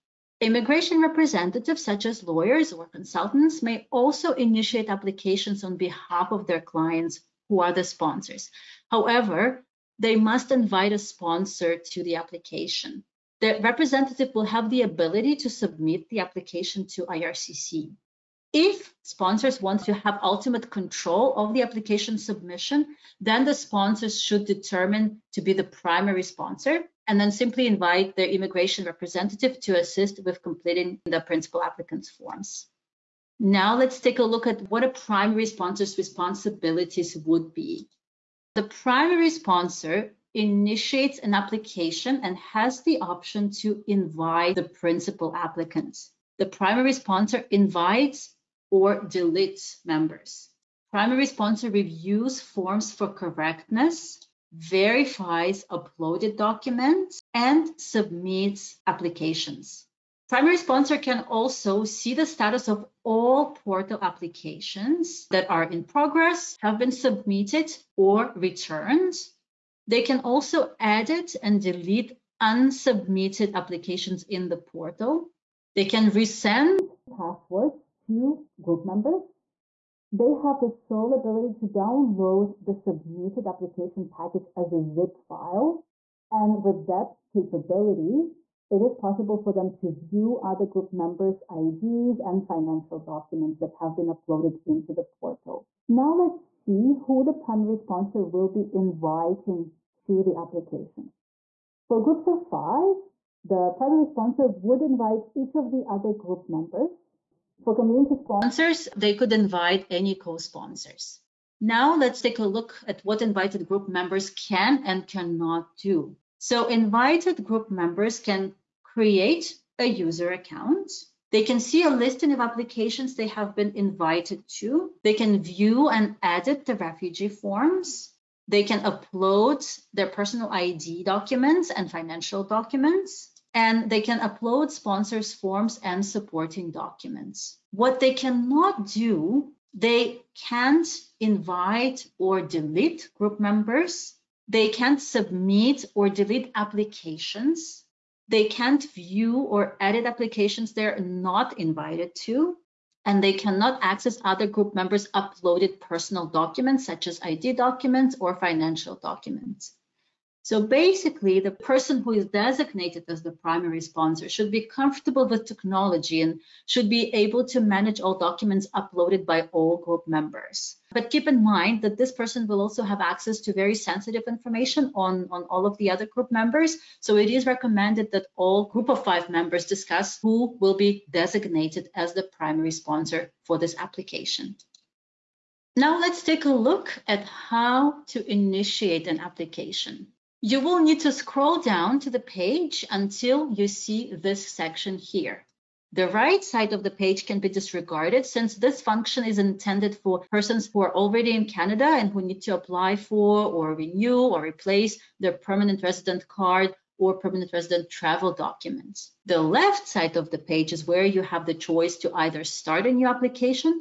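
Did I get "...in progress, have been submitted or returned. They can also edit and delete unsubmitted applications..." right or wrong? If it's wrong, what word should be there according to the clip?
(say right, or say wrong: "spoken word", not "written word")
right.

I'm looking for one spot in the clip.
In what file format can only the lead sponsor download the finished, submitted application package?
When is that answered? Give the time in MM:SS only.
01:24.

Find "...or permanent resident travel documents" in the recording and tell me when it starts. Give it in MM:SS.
03:26.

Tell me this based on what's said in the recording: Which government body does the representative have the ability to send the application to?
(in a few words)
IRCC.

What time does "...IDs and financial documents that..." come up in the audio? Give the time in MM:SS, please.
01:31.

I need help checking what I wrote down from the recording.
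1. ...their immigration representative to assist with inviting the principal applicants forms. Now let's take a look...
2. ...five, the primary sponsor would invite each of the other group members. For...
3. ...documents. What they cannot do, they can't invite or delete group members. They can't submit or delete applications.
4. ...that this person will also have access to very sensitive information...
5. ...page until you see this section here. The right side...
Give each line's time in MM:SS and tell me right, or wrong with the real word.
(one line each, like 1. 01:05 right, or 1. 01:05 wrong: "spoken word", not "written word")
1. 00:28 wrong: "completing", not "inviting"
2. 01:42 right
3. 02:16 right
4. 02:51 right
5. 03:12 right.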